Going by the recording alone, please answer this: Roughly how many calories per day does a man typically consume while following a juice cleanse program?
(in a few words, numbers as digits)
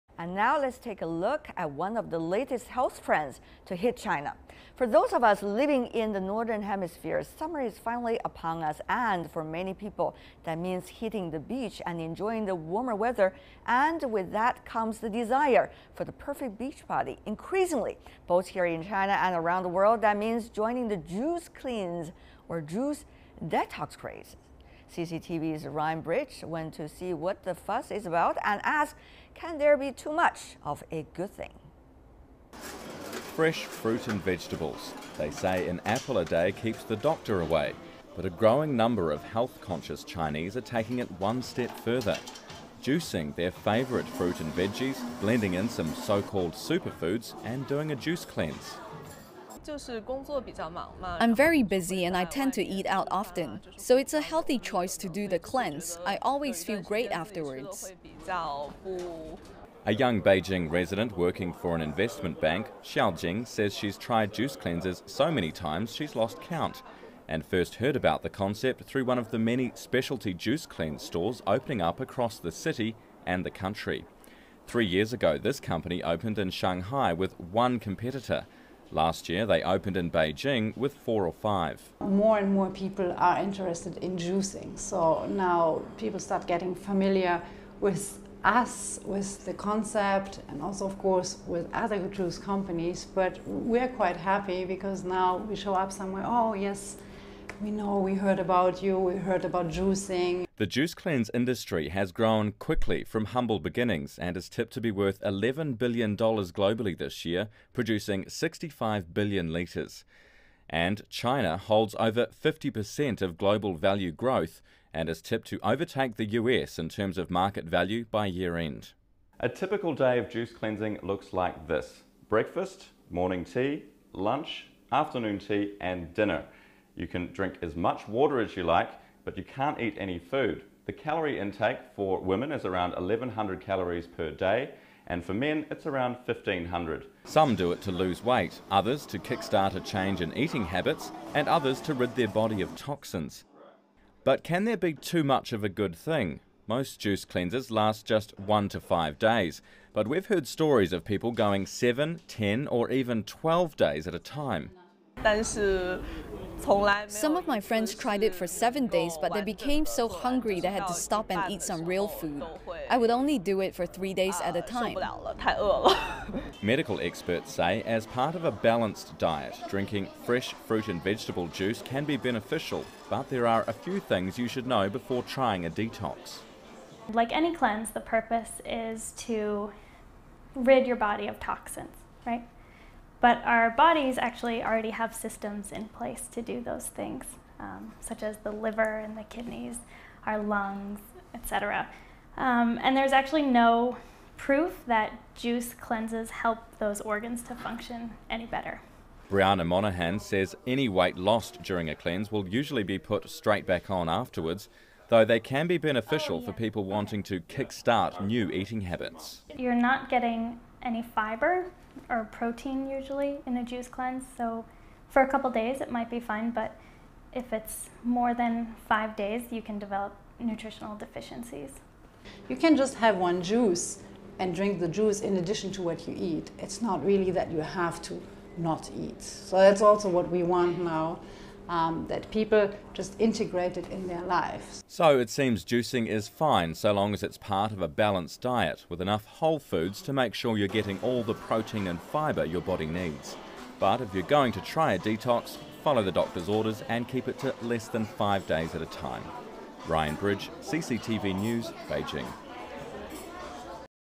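1500.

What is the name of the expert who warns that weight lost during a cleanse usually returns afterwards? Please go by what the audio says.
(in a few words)
Brianna Monahan.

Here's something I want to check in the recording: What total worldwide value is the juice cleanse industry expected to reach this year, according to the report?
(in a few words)
$11 billion.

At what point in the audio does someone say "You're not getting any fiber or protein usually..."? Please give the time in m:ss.
3:29.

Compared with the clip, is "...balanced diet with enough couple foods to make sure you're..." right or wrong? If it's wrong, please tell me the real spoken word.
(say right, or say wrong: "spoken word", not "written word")
wrong: "whole", not "couple".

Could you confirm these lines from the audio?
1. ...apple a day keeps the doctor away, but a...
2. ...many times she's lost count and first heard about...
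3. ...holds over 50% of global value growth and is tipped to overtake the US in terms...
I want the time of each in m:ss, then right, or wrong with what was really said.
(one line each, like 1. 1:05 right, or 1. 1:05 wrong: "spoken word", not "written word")
1. 0:35 right
2. 1:05 right
3. 1:51 right.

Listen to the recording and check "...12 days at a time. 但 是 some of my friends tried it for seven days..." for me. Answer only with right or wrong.
right.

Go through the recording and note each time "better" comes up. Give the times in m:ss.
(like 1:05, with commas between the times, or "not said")
3:18.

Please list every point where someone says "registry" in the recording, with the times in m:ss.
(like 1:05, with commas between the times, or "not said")
not said.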